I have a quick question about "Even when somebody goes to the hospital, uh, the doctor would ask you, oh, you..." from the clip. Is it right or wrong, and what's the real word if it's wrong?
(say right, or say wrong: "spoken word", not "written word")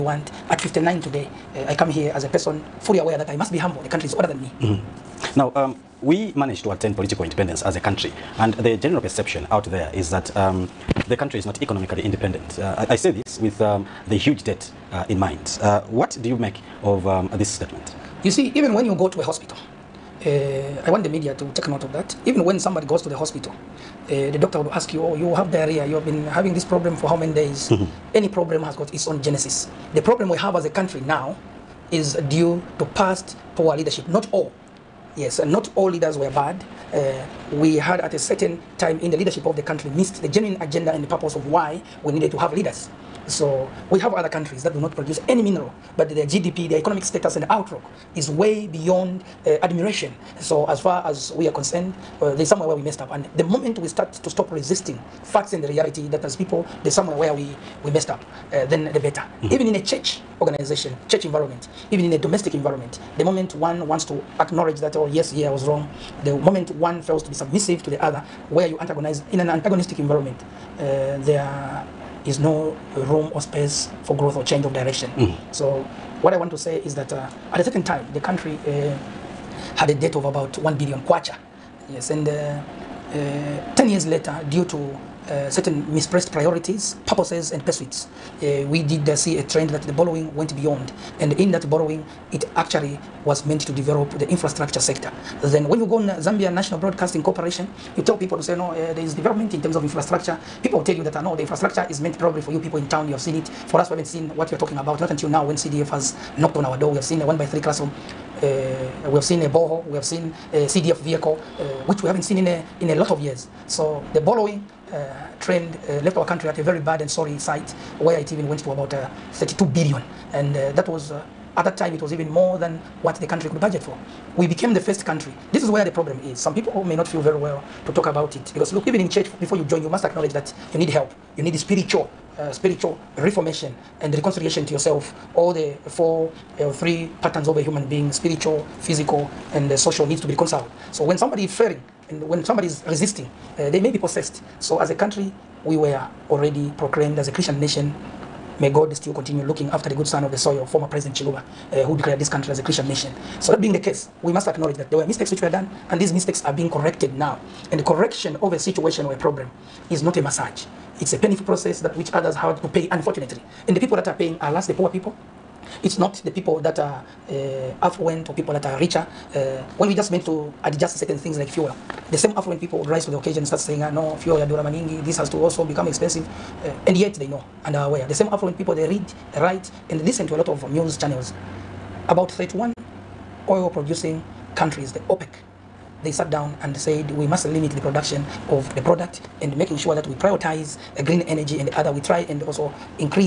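right.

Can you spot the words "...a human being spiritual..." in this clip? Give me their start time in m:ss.
2:17.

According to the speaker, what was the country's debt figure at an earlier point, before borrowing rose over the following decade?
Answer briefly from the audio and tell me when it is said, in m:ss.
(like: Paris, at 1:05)
1 billion kwacha, at 1:20.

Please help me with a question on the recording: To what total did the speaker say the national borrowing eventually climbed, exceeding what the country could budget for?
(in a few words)
32 billion.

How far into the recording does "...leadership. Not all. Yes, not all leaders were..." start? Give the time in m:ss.
0:33.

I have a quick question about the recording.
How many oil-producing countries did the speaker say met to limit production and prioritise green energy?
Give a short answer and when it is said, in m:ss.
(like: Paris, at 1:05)
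31, at 3:02.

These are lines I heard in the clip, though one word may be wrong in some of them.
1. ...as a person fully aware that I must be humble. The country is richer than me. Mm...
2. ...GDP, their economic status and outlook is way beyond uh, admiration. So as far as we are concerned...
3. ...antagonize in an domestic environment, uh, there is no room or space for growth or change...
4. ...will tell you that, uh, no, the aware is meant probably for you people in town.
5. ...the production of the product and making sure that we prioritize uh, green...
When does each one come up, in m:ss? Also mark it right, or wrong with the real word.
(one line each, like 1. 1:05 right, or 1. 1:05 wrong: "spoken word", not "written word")
1. 0:02 wrong: "older", not "richer"
2. 0:46 right
3. 1:08 wrong: "antagonistic", not "domestic"
4. 1:40 wrong: "infrastructure", not "aware"
5. 3:07 right.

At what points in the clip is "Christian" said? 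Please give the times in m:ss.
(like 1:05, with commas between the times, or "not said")
2:27, 2:32.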